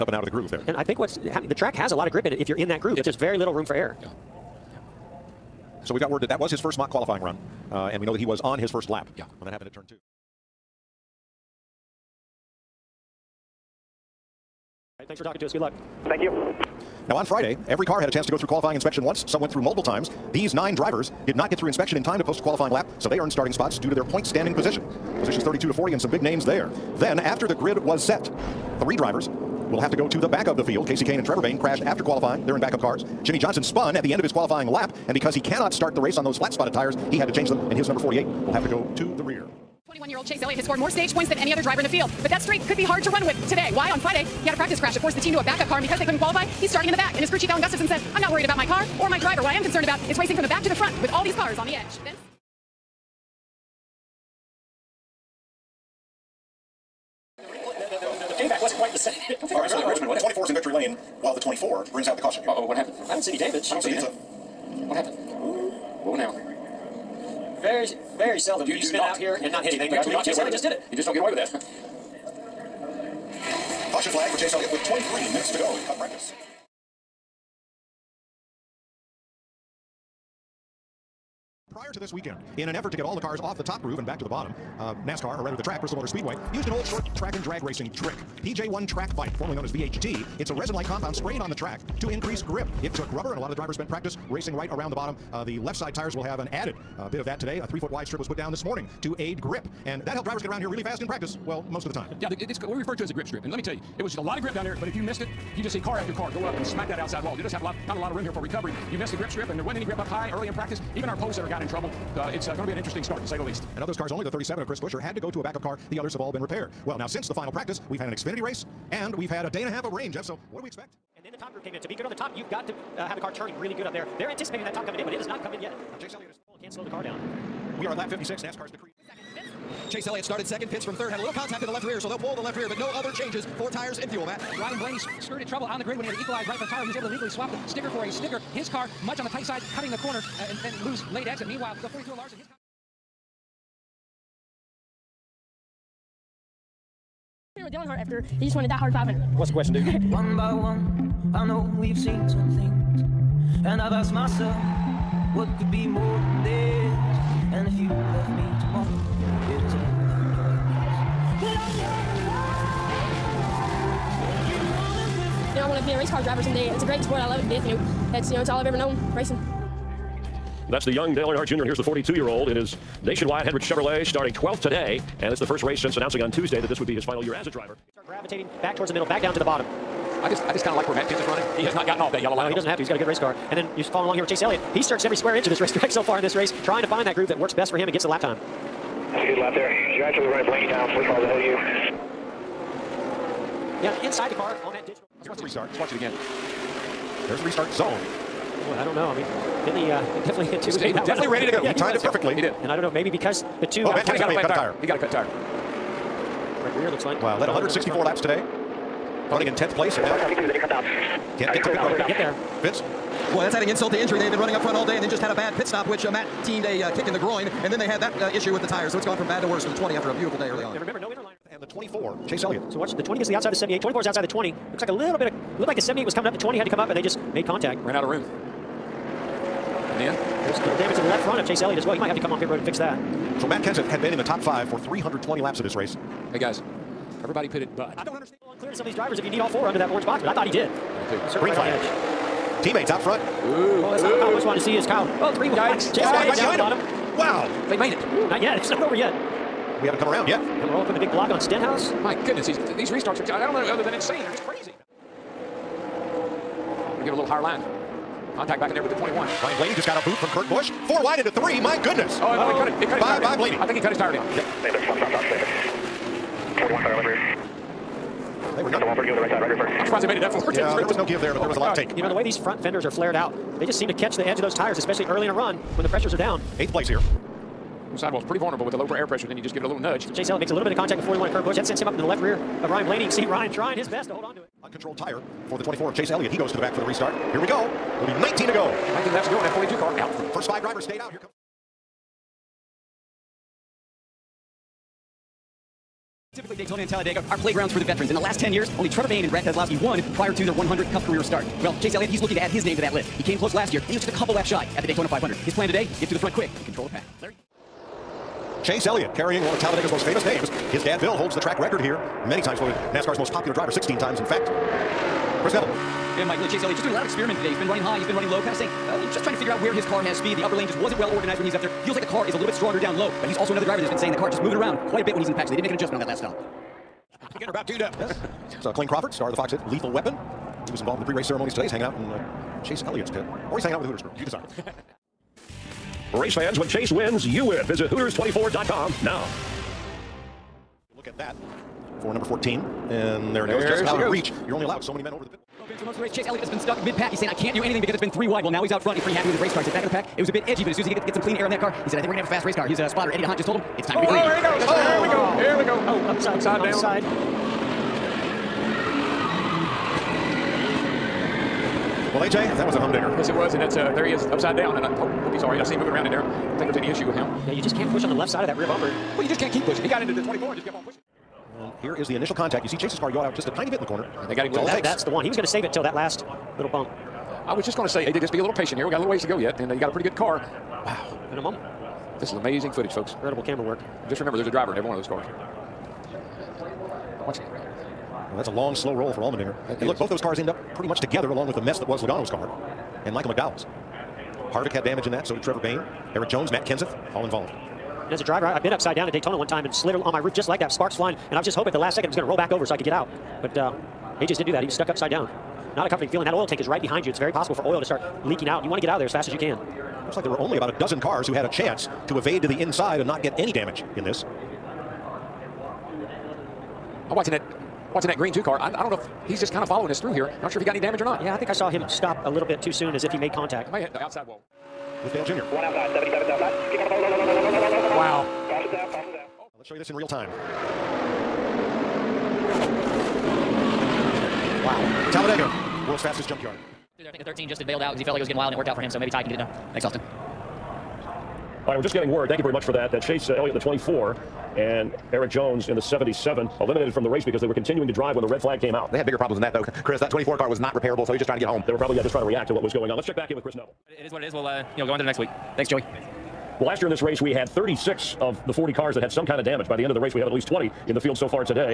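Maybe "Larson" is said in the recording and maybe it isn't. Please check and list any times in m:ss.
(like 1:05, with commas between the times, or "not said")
2:22.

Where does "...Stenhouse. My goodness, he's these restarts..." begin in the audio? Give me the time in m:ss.
4:11.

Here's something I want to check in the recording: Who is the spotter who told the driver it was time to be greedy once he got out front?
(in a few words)
Eddie D'Hondt.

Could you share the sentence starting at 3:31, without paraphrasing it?
road not get there Vince Boy, that's adding insult to injury.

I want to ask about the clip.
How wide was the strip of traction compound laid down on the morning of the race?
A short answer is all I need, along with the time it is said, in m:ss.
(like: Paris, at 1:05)
3 feet, at 1:37.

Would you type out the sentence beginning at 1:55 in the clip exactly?
The others have all been repaired.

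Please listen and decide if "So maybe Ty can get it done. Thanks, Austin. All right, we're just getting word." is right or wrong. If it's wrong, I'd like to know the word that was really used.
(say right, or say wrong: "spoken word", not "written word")
right.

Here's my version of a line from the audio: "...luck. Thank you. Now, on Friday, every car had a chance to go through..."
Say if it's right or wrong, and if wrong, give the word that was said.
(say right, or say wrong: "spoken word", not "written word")
right.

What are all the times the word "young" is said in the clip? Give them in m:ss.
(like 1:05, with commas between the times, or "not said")
2:50.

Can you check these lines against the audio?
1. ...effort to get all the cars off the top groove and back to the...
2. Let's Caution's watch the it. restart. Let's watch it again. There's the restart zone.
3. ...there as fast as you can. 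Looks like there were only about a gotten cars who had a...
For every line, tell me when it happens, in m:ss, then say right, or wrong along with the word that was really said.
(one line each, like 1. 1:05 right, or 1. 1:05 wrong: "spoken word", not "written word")
1. 1:22 right
2. 3:15 wrong: "Here", not "Caution"
3. 6:48 wrong: "dozen", not "gotten".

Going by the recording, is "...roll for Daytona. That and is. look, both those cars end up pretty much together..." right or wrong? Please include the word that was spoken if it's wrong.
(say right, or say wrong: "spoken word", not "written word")
wrong: "Allmendinger", not "Daytona".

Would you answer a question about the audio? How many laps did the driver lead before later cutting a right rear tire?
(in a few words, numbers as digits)
164.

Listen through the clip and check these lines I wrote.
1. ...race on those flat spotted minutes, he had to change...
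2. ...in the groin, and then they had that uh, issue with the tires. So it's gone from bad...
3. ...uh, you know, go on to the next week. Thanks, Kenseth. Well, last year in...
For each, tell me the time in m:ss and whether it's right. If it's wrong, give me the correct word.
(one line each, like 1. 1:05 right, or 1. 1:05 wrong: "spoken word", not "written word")
1. 0:36 wrong: "tires", not "minutes"
2. 3:37 right
3. 7:34 wrong: "Joey", not "Kenseth".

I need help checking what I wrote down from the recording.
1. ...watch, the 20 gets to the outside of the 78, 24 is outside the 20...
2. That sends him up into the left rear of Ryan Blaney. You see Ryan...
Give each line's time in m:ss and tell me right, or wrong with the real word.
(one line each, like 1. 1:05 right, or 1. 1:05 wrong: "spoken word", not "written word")
1. 3:42 right
2. 4:41 right.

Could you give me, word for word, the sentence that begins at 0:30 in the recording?
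Kasey Kahne and Trevor Bayne crashed after qualifying.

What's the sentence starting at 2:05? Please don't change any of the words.
Now Chase Elliott is still and can't slow the car down.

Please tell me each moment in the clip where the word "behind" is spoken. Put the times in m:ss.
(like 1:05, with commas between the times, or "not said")
4:06, 6:46.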